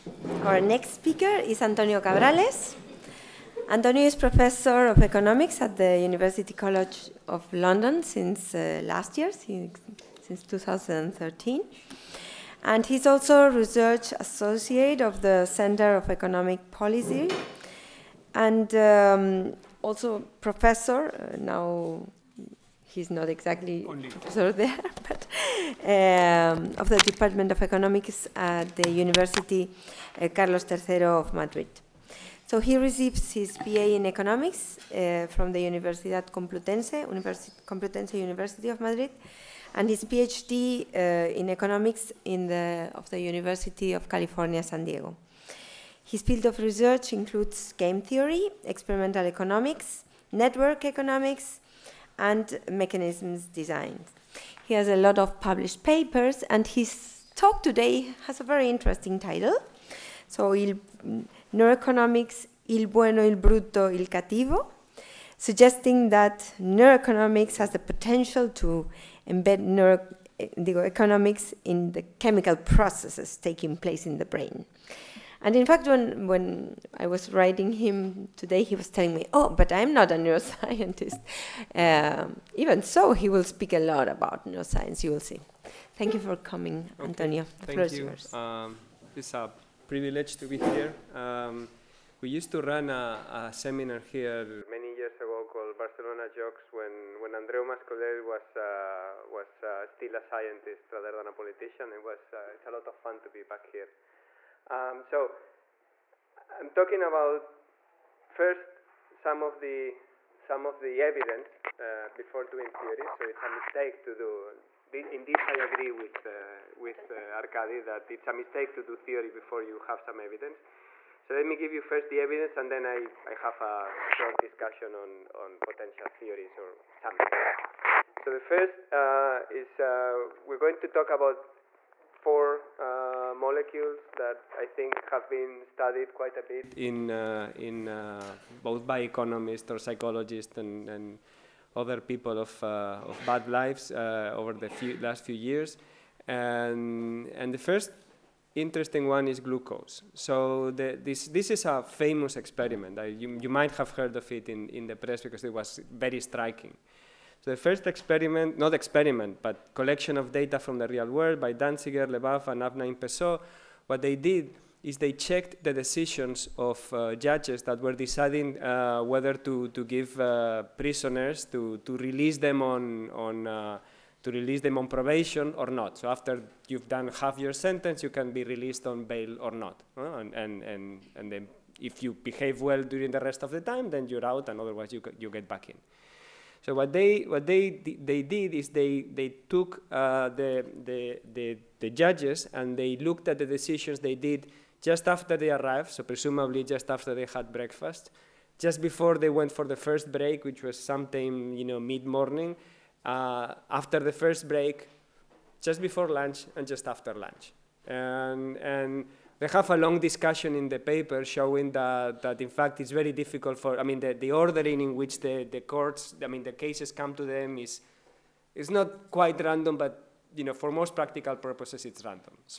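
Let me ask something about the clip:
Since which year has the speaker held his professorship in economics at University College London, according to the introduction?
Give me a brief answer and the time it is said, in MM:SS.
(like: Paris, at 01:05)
2013, at 00:10.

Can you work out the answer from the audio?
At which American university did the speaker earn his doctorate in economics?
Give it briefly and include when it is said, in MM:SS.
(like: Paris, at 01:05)
University of California, San Diego, at 00:43.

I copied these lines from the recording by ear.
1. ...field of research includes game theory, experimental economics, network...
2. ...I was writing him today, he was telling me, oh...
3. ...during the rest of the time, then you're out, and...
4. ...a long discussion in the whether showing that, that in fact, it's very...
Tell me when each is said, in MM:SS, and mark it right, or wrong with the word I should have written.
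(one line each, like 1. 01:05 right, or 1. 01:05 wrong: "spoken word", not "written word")
1. 00:46 right
2. 01:16 right
3. 03:02 right
4. 03:29 wrong: "paper", not "whether".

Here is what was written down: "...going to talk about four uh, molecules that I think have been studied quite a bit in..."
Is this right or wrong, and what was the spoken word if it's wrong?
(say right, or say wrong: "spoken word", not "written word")
right.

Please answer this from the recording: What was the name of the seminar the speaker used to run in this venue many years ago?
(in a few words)
Barcelona Jocs.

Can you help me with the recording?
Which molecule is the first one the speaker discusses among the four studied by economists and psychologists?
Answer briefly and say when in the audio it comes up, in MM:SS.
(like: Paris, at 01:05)
Glucose, at 02:29.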